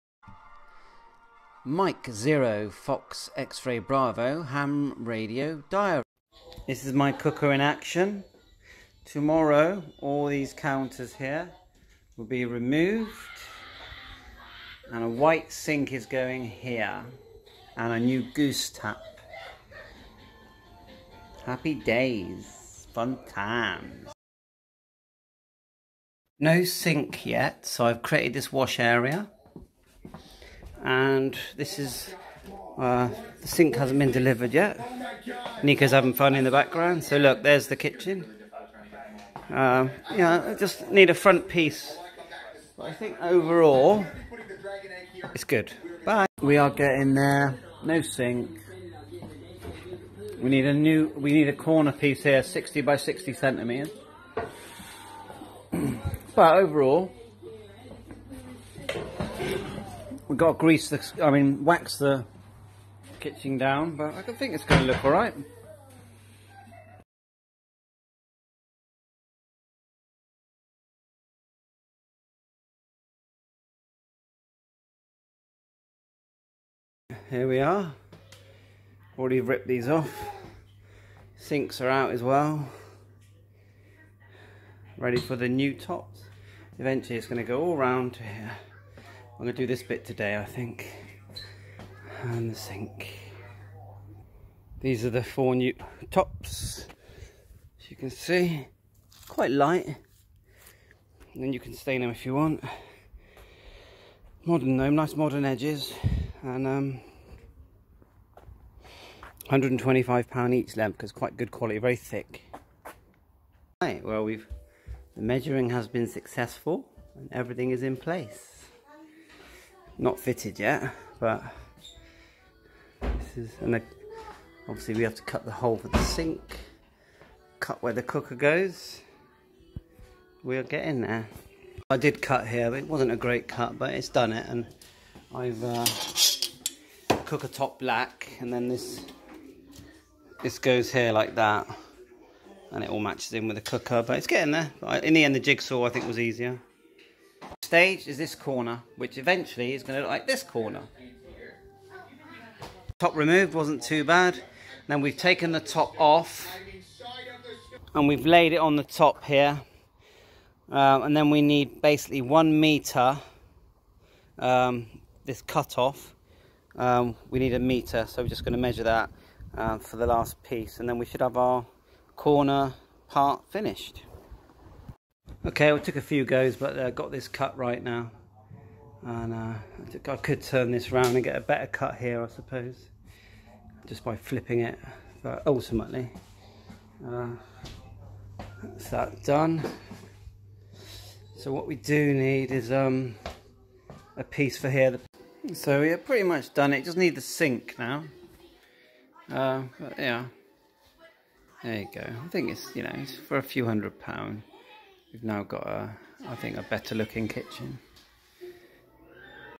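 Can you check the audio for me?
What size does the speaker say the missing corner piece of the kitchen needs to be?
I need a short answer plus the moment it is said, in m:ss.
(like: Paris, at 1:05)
60 by 60 centimeters, at 0:52.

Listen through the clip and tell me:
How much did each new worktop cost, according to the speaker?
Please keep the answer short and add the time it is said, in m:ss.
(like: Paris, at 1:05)
£125, at 1:49.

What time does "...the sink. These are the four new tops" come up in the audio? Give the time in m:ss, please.
1:32.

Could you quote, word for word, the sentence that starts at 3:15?
So we're pretty much done it.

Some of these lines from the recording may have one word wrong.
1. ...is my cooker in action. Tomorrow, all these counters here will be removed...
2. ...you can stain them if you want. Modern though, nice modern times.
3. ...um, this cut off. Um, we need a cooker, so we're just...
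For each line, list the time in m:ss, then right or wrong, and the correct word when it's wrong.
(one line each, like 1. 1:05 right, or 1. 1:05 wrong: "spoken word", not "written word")
1. 0:06 right
2. 1:41 wrong: "edges", not "times"
3. 2:44 wrong: "meter", not "cooker".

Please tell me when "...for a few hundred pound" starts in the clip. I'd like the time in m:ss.
3:23.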